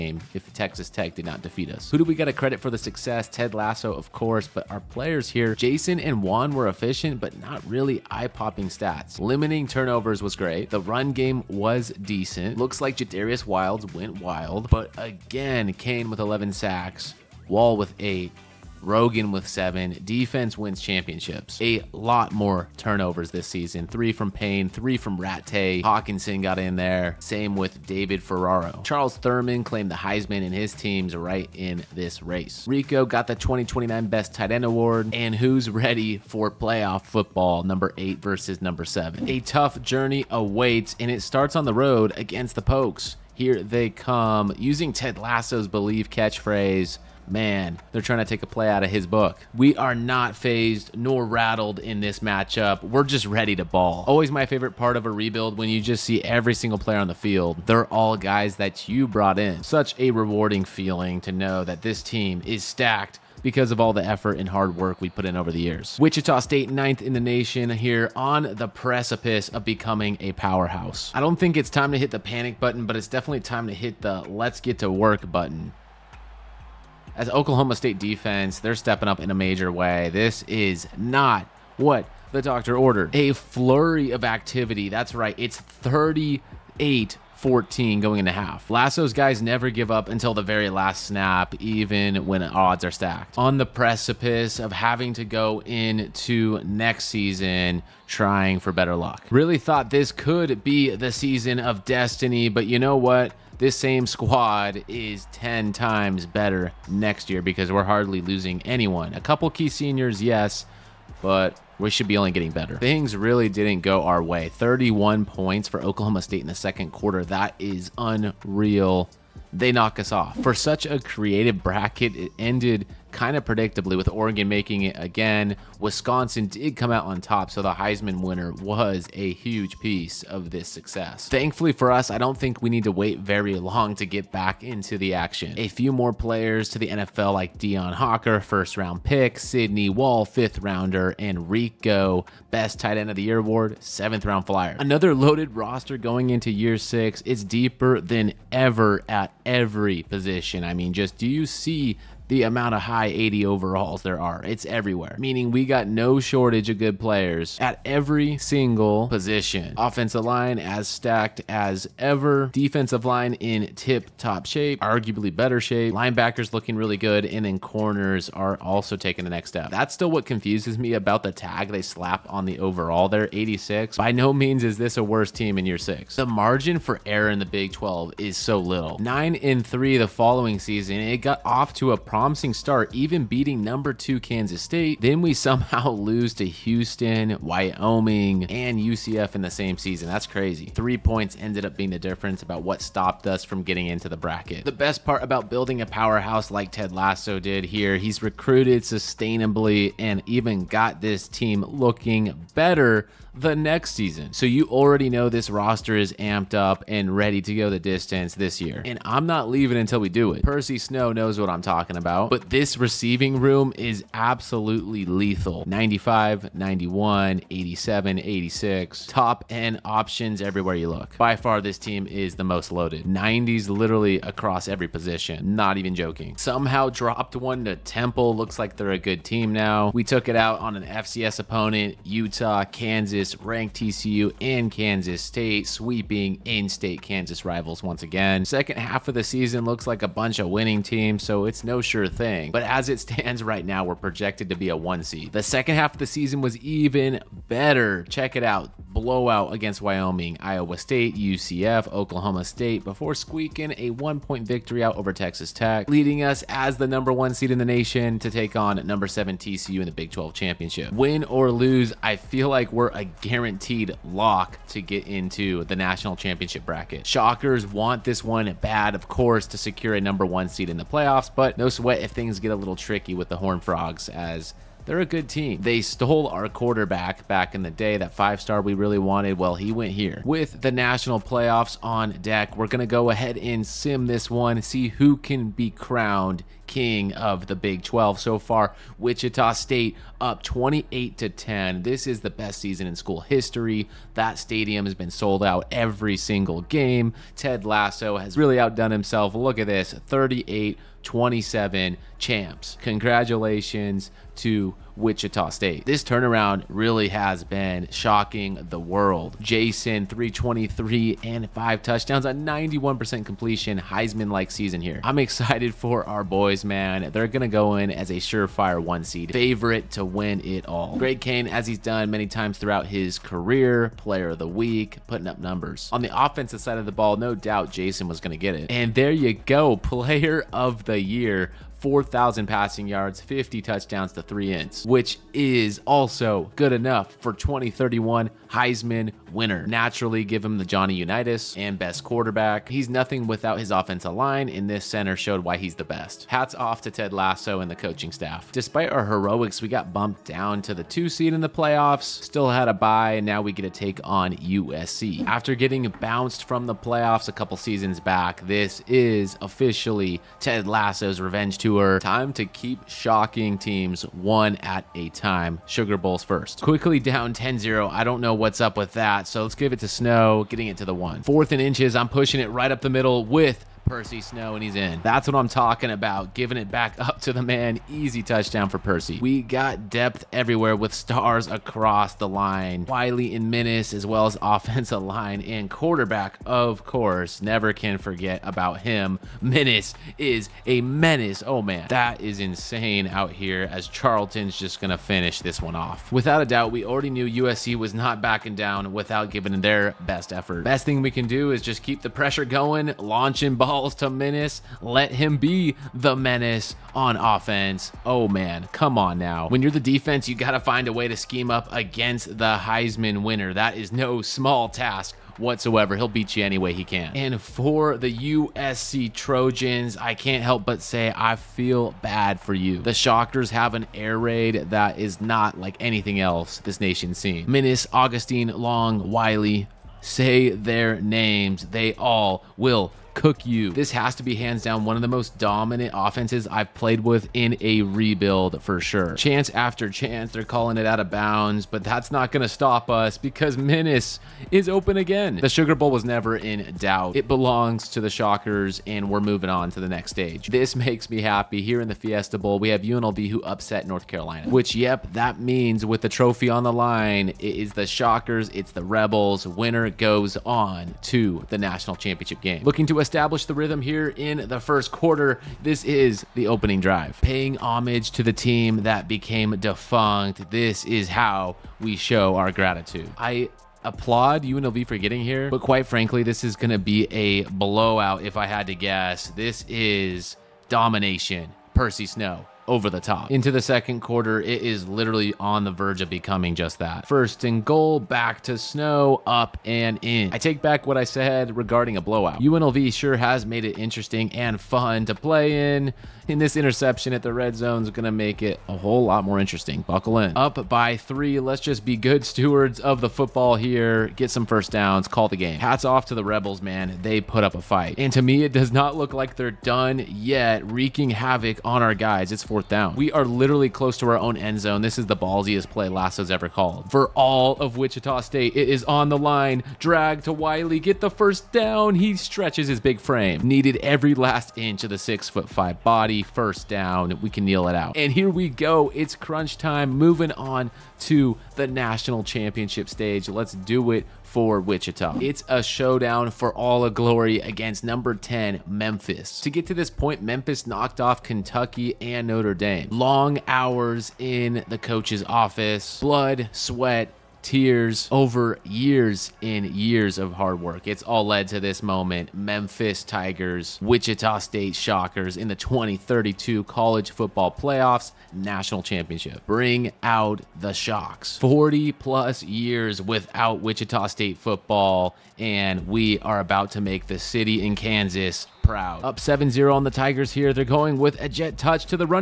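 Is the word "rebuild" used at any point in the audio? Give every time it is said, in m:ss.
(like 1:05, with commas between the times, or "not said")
0:55, 7:17.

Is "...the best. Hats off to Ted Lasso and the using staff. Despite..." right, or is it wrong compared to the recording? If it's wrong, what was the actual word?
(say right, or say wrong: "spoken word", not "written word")
wrong: "coaching", not "using".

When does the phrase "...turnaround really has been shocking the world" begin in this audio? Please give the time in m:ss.
5:06.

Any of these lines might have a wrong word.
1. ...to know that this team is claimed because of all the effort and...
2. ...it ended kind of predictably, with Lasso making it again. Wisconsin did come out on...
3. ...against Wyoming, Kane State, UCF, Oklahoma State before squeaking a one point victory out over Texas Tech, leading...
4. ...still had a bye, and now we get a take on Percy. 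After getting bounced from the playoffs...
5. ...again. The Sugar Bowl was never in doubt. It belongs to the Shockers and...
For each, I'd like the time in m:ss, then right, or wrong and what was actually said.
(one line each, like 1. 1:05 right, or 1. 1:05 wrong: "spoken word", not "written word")
1. 1:01 wrong: "stacked", not "claimed"
2. 2:02 wrong: "Oregon", not "Lasso"
3. 4:09 wrong: "Iowa", not "Kane"
4. 5:52 wrong: "USC", not "Percy"
5. 7:24 right.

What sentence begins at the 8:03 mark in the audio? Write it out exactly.
Into the second quarter, it is literally on the verge of becoming just that.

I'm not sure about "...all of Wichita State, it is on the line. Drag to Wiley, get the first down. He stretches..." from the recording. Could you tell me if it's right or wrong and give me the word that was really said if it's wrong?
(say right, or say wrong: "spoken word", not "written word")
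right.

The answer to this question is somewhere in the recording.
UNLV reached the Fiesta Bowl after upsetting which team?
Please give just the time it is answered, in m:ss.
7:33.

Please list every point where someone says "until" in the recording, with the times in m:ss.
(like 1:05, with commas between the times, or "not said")
1:30, 3:29.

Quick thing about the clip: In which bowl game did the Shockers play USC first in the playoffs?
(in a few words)
Sugar Bowl.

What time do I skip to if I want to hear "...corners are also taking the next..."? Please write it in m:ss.
2:47.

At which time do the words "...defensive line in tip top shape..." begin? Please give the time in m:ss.
2:42.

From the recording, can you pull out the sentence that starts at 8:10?
I take back what I said regarding a blowout.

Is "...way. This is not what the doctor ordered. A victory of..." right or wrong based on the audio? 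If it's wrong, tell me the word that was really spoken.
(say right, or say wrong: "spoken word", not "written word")
wrong: "flurry", not "victory".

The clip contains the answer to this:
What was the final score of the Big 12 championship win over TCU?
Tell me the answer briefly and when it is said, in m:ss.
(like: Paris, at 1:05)
38-27, at 4:59.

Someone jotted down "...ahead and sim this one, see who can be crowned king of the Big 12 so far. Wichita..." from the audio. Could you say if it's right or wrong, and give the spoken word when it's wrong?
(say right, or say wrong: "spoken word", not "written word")
right.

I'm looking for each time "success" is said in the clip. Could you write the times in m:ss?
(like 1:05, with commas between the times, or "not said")
0:02, 2:10.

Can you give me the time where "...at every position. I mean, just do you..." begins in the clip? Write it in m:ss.
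2:29.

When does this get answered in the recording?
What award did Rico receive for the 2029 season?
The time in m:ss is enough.
0:34.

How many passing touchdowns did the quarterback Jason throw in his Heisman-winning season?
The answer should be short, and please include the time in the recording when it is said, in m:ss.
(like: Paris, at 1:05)
50, at 5:33.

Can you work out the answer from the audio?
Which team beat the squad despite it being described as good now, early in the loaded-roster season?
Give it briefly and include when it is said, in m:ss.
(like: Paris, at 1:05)
Temple, at 3:47.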